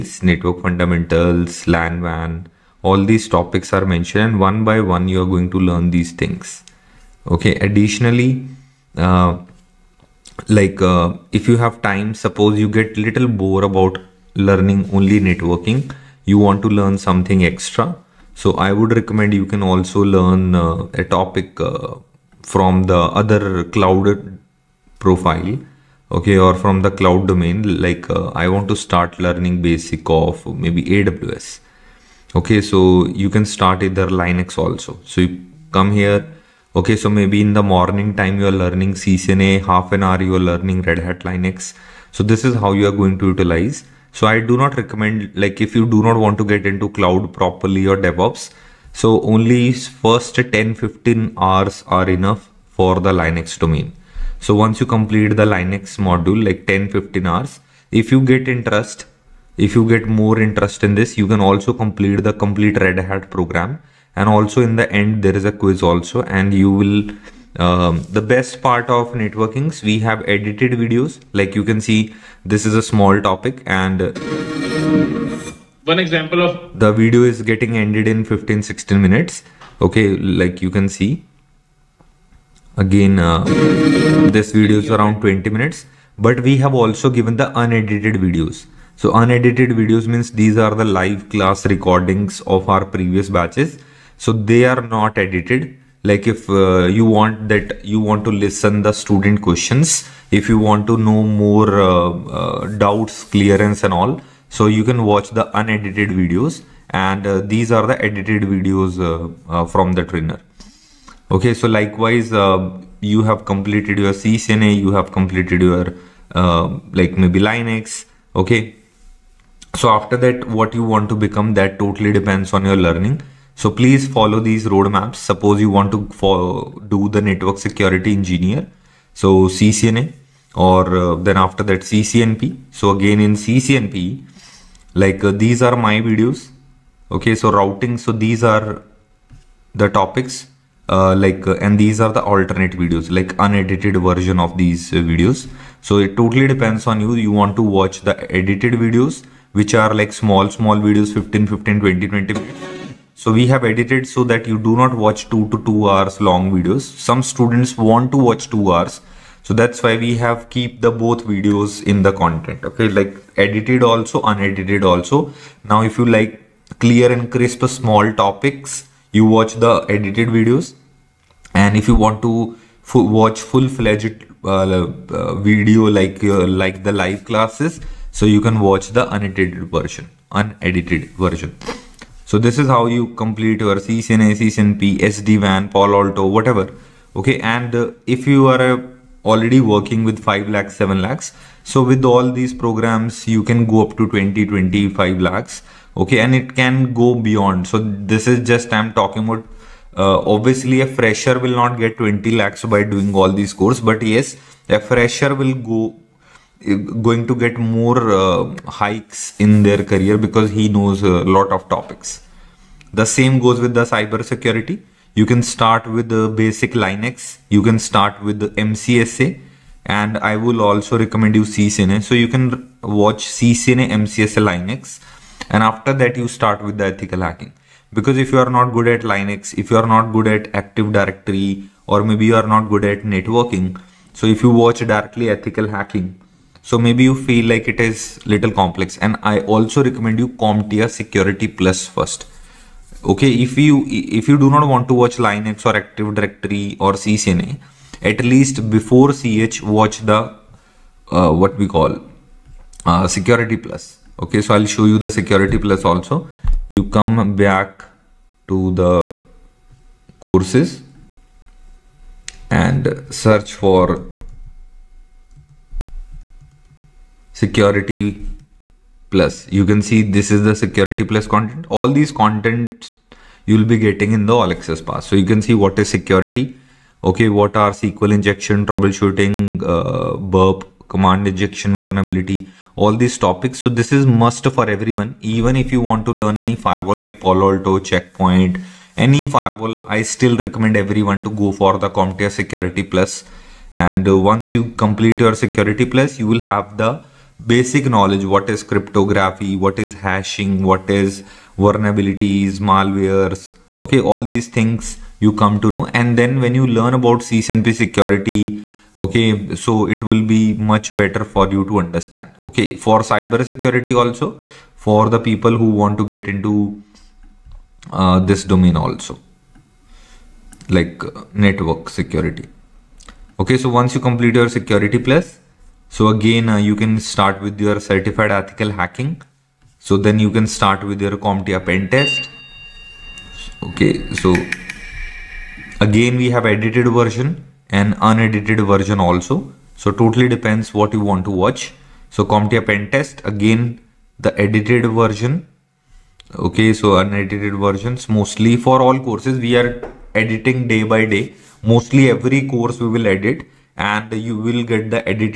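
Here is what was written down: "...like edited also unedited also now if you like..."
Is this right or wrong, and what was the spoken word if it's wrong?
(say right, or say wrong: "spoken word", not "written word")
right.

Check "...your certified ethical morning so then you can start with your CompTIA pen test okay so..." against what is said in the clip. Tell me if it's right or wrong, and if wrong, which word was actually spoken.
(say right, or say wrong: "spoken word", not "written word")
wrong: "hacking", not "morning".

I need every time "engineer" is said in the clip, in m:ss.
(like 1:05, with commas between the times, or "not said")
2:08.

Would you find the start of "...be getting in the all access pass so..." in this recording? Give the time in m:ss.
4:33.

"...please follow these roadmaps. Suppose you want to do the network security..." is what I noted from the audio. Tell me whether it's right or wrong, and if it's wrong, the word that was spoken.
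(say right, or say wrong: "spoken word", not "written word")
right.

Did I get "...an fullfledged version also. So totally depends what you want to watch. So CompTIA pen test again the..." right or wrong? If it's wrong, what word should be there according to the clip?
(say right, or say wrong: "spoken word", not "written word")
wrong: "unedited", not "fullfledged".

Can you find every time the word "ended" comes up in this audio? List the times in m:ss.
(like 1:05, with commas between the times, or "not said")
1:17.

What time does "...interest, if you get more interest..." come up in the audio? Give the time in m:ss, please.
0:58.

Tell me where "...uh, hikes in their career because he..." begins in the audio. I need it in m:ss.
3:28.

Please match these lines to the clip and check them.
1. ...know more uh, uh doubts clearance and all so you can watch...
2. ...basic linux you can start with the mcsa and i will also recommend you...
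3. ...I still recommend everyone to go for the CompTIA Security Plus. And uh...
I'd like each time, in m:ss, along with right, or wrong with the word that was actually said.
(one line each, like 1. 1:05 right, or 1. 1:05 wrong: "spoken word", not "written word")
1. 1:41 right
2. 3:36 right
3. 4:49 right.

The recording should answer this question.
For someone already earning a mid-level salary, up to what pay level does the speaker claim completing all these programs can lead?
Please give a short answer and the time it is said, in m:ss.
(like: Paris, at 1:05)
20-25 lakhs, at 3:14.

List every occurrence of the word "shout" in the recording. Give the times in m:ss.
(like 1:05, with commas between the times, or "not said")
not said.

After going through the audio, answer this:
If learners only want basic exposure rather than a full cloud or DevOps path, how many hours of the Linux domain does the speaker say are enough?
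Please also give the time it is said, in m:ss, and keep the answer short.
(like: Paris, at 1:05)
10-15 hours, at 0:50.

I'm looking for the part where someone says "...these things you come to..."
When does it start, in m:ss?
5:04.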